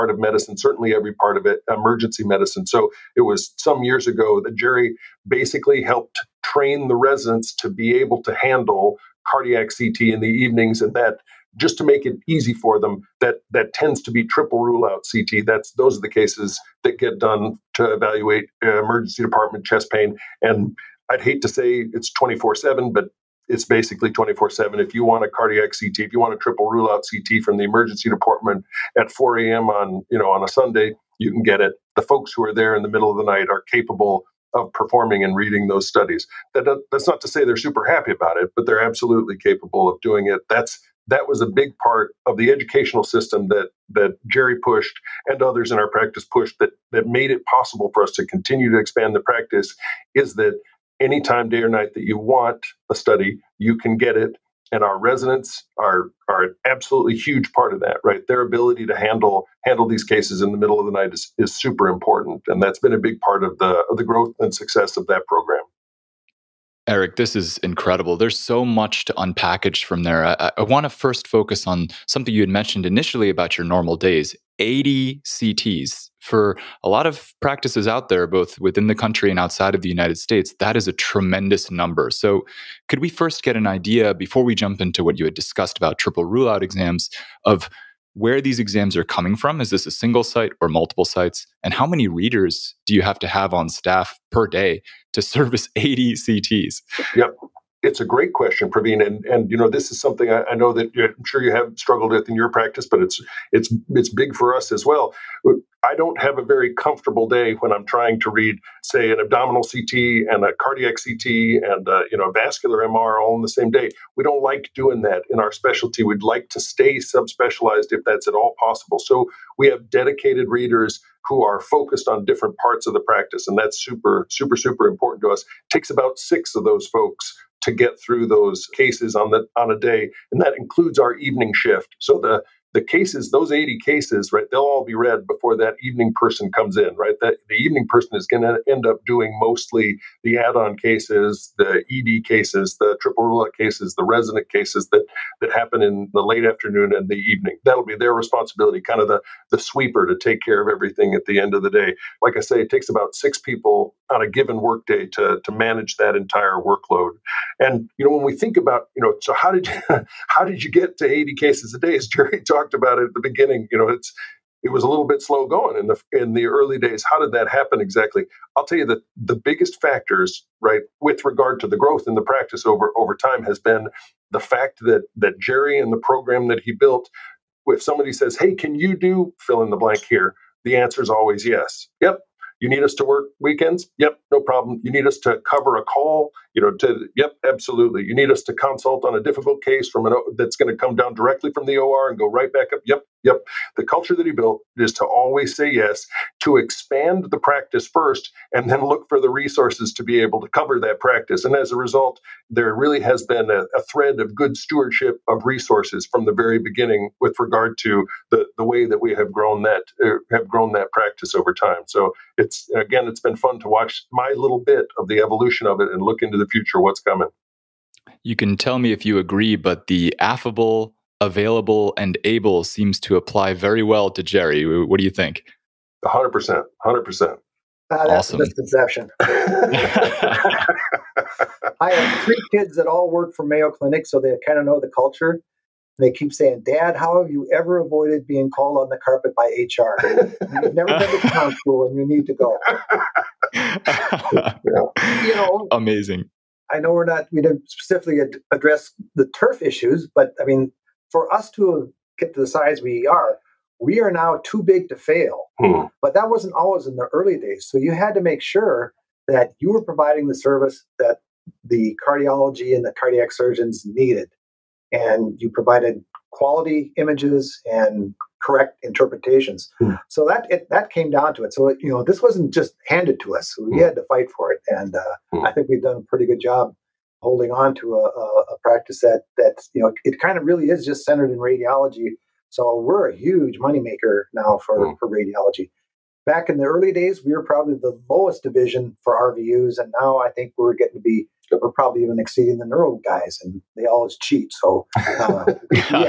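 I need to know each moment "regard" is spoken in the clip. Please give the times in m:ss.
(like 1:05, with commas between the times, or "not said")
2:51, 3:27.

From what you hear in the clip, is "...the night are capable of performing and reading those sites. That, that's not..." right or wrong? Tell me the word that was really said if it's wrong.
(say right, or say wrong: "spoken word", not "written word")
wrong: "studies", not "sites".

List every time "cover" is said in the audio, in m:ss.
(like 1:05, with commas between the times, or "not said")
3:05, 3:20.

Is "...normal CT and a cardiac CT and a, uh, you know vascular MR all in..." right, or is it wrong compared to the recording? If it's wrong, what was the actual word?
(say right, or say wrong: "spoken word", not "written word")
wrong: "abdominal", not "normal".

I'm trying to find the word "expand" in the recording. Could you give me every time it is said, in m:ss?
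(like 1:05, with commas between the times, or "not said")
0:48, 3:16.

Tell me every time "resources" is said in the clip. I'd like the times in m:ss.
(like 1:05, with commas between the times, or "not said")
3:19, 3:25.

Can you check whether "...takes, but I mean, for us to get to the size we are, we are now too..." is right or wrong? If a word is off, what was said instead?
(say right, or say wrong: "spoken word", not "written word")
wrong: "issues", not "takes".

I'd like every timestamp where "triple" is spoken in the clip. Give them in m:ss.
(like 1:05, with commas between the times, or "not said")
0:14, 0:26, 1:25, 2:22.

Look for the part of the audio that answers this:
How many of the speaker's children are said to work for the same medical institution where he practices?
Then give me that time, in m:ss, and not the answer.
3:52.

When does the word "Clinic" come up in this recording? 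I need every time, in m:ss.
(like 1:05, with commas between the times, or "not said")
3:53.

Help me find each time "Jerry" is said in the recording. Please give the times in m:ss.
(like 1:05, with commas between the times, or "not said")
0:04, 0:44, 2:42, 2:55, 3:44.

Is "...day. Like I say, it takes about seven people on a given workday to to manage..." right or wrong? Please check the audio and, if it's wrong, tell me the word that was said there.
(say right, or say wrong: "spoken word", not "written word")
wrong: "six", not "seven".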